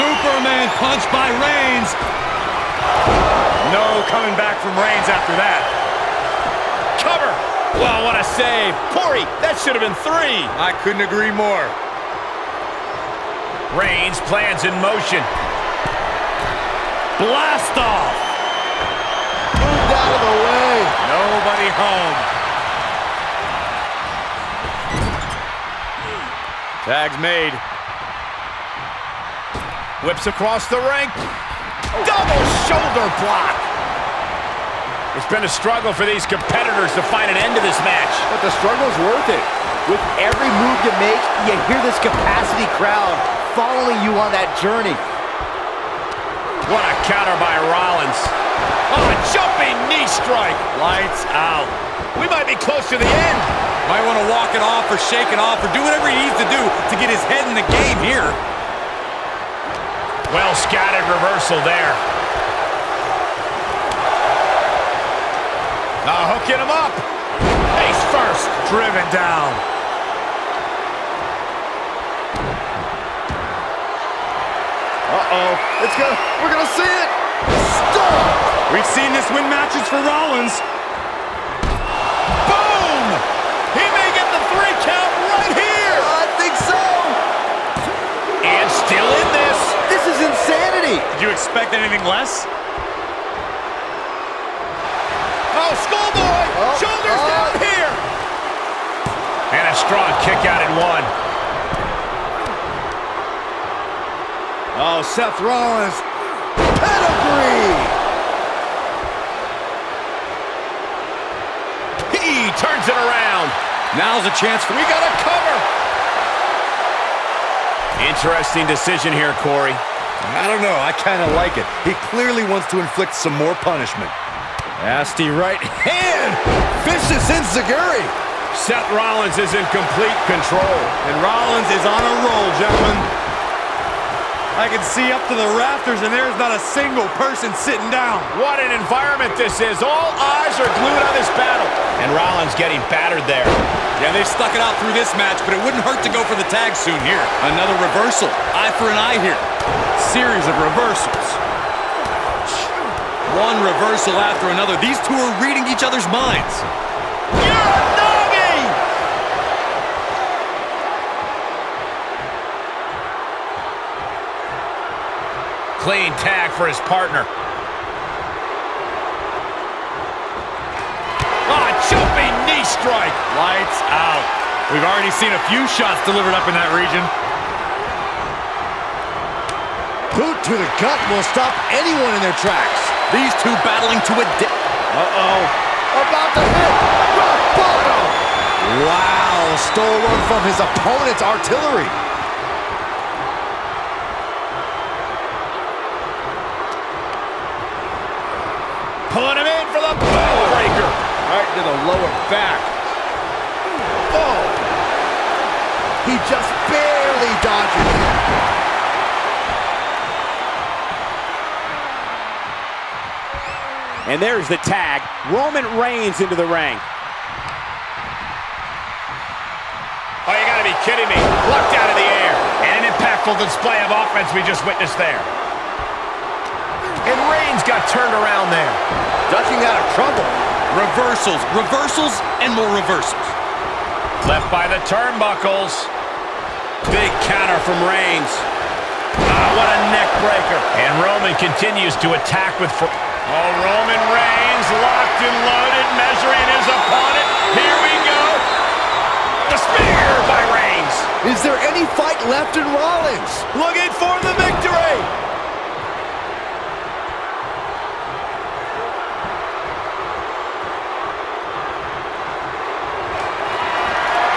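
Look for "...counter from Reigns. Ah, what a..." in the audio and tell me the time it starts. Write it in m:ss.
3:57.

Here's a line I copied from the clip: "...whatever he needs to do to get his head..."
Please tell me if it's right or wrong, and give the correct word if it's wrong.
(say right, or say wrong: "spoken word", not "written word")
right.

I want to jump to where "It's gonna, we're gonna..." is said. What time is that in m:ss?
1:15.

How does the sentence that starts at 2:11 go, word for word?
And Rollins is on a roll, gentlemen.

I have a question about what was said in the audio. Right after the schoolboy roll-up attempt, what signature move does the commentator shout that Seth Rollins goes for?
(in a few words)
Pedigree.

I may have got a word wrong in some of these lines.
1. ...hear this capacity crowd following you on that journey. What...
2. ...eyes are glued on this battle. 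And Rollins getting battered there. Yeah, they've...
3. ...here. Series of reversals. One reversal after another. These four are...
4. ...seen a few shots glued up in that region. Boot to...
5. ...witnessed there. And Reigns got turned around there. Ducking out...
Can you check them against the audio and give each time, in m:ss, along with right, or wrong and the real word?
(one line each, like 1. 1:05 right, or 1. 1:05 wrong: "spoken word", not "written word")
1. 0:41 right
2. 2:20 right
3. 2:29 wrong: "two", not "four"
4. 2:55 wrong: "delivered", not "glued"
5. 3:44 right.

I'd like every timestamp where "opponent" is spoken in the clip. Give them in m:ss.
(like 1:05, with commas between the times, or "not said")
3:10, 4:06.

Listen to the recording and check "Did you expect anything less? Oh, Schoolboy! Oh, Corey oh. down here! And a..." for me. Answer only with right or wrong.
wrong.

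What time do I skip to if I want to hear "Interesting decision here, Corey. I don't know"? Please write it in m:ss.
1:58.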